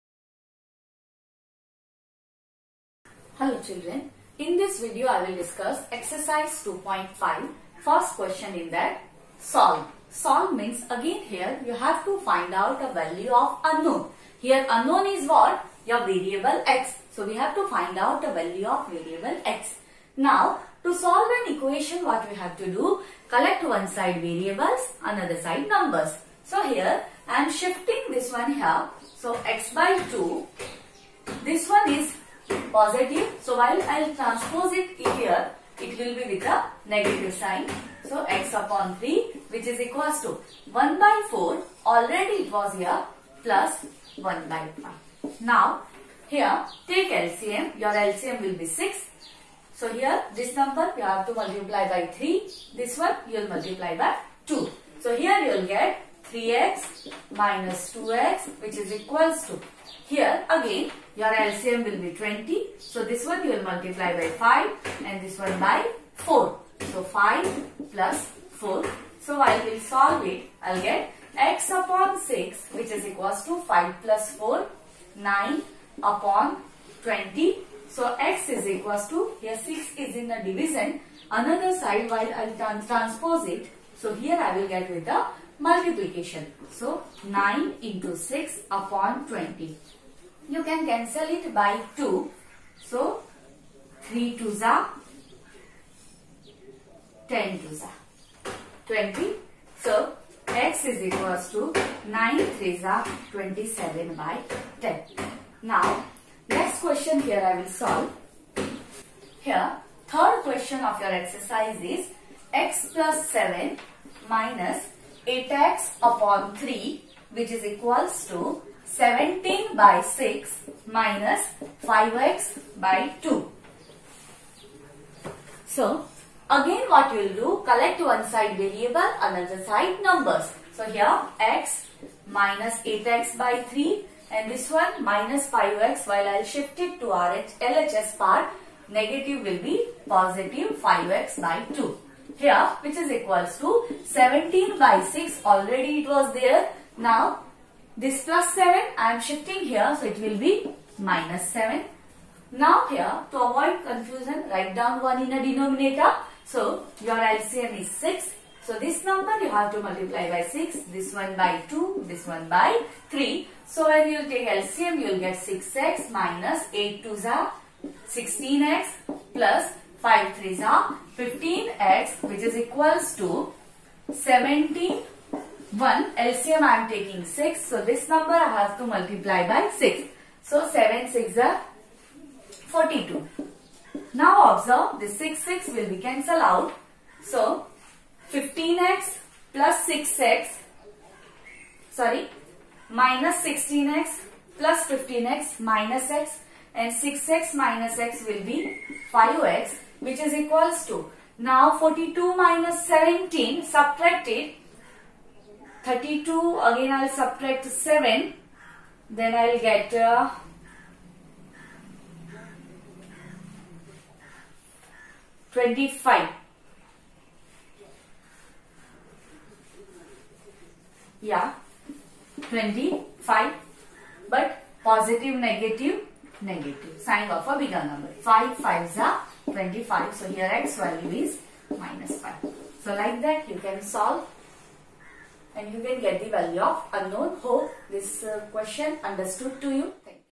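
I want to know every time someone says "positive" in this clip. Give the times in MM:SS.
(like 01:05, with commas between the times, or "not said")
00:32, 02:20, 03:44.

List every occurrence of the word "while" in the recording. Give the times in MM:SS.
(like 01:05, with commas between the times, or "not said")
00:33, 01:22, 02:16.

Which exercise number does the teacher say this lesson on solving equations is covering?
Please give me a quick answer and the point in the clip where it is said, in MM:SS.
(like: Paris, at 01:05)
2.5, at 00:05.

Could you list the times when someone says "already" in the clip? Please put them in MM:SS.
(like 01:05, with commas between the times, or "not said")
00:41, 02:25.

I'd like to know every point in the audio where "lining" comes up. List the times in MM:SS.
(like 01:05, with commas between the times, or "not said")
not said.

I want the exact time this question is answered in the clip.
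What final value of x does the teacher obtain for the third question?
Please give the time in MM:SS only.
03:51.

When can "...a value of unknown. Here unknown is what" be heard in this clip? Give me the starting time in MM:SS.
00:12.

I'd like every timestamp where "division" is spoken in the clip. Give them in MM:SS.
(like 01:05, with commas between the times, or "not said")
01:20.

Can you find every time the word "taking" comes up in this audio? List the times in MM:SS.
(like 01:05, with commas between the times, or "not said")
02:56.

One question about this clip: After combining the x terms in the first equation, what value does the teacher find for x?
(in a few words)
27/10.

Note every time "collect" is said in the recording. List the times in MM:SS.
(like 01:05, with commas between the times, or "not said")
00:23, 02:07.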